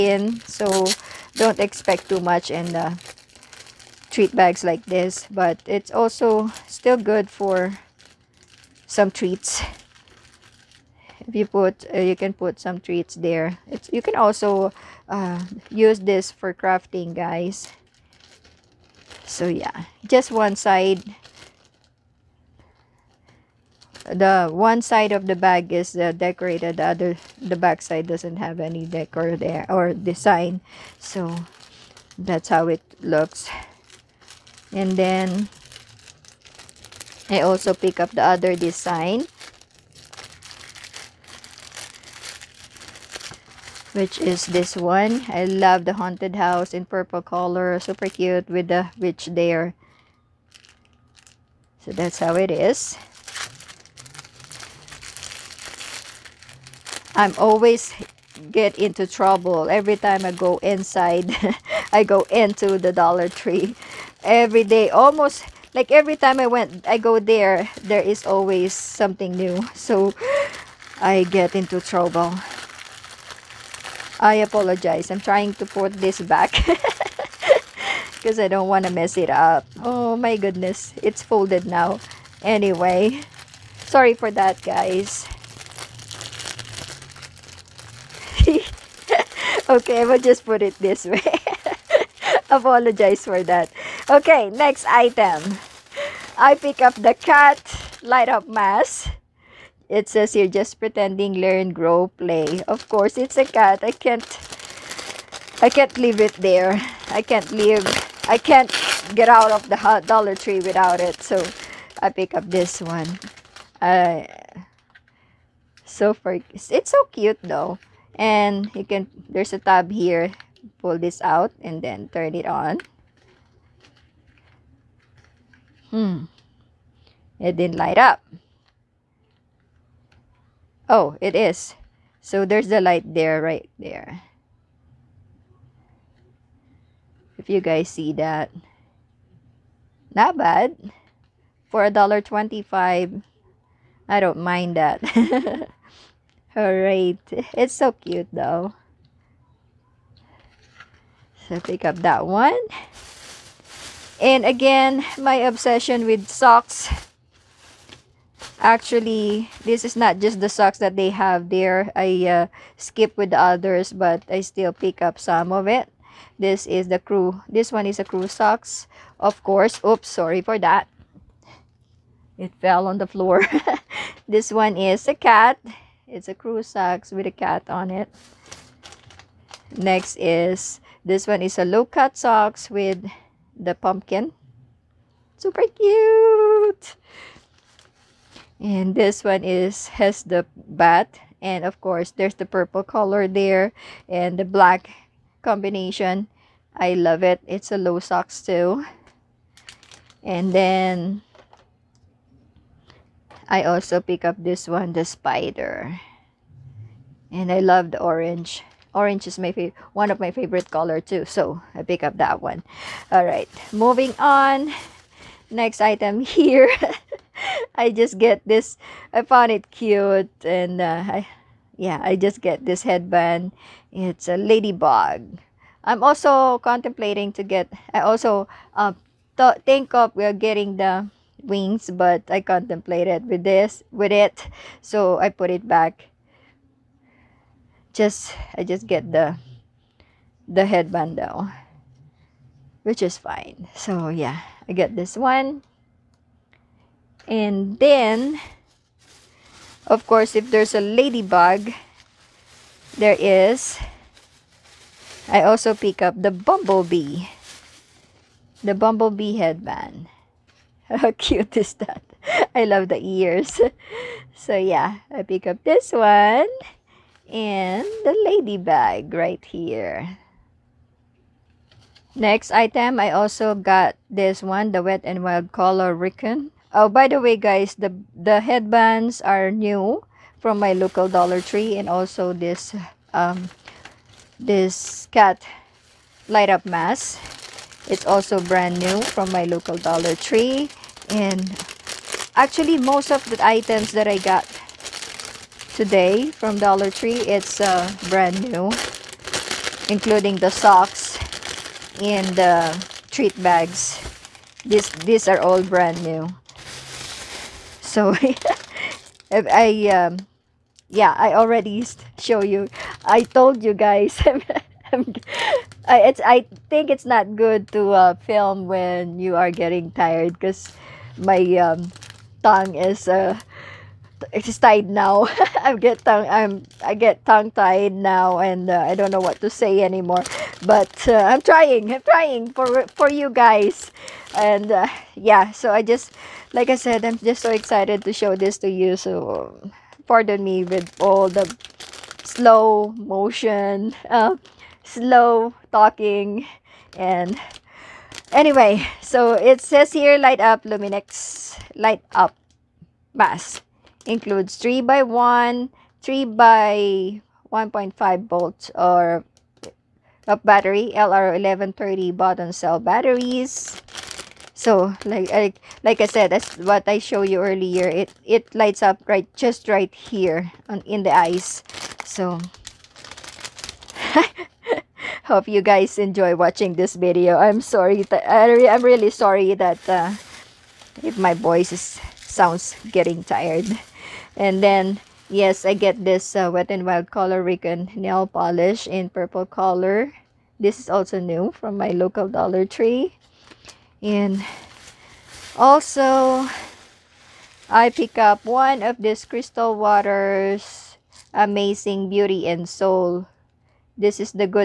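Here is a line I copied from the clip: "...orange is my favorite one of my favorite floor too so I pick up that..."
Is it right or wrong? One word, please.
wrong.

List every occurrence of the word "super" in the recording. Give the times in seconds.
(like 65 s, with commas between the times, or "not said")
47 s, 185 s.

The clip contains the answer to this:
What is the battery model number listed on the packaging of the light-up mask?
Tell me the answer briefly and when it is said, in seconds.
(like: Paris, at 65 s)
LR1130, at 360 s.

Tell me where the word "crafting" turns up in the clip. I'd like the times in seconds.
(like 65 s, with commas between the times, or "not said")
16 s.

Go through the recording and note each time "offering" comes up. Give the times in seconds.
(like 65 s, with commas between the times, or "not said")
not said.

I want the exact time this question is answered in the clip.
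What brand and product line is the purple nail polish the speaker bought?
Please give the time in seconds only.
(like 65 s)
386 s.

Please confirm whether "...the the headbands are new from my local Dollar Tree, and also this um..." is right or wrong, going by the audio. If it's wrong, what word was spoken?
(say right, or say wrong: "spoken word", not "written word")
right.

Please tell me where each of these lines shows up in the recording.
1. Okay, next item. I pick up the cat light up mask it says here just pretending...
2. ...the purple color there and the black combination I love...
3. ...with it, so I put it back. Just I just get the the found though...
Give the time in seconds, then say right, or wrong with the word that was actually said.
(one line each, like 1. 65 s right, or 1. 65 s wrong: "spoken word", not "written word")
1. 94 s right
2. 192 s right
3. 233 s wrong: "headband", not "found".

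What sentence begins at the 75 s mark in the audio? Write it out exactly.
I'm trying to put this back.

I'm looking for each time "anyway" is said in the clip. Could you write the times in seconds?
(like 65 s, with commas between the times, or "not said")
82 s, 348 s.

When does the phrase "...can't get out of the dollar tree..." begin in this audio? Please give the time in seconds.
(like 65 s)
108 s.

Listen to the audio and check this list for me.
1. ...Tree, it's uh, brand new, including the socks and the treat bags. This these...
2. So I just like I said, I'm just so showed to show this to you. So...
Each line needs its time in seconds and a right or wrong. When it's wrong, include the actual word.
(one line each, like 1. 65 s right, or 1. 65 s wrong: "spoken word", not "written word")
1. 296 s right
2. 335 s wrong: "excited", not "showed".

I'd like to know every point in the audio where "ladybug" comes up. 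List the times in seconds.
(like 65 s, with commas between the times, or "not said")
224 s, 250 s, 268 s.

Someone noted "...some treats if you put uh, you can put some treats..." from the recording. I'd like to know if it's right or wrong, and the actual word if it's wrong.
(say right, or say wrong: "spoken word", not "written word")
right.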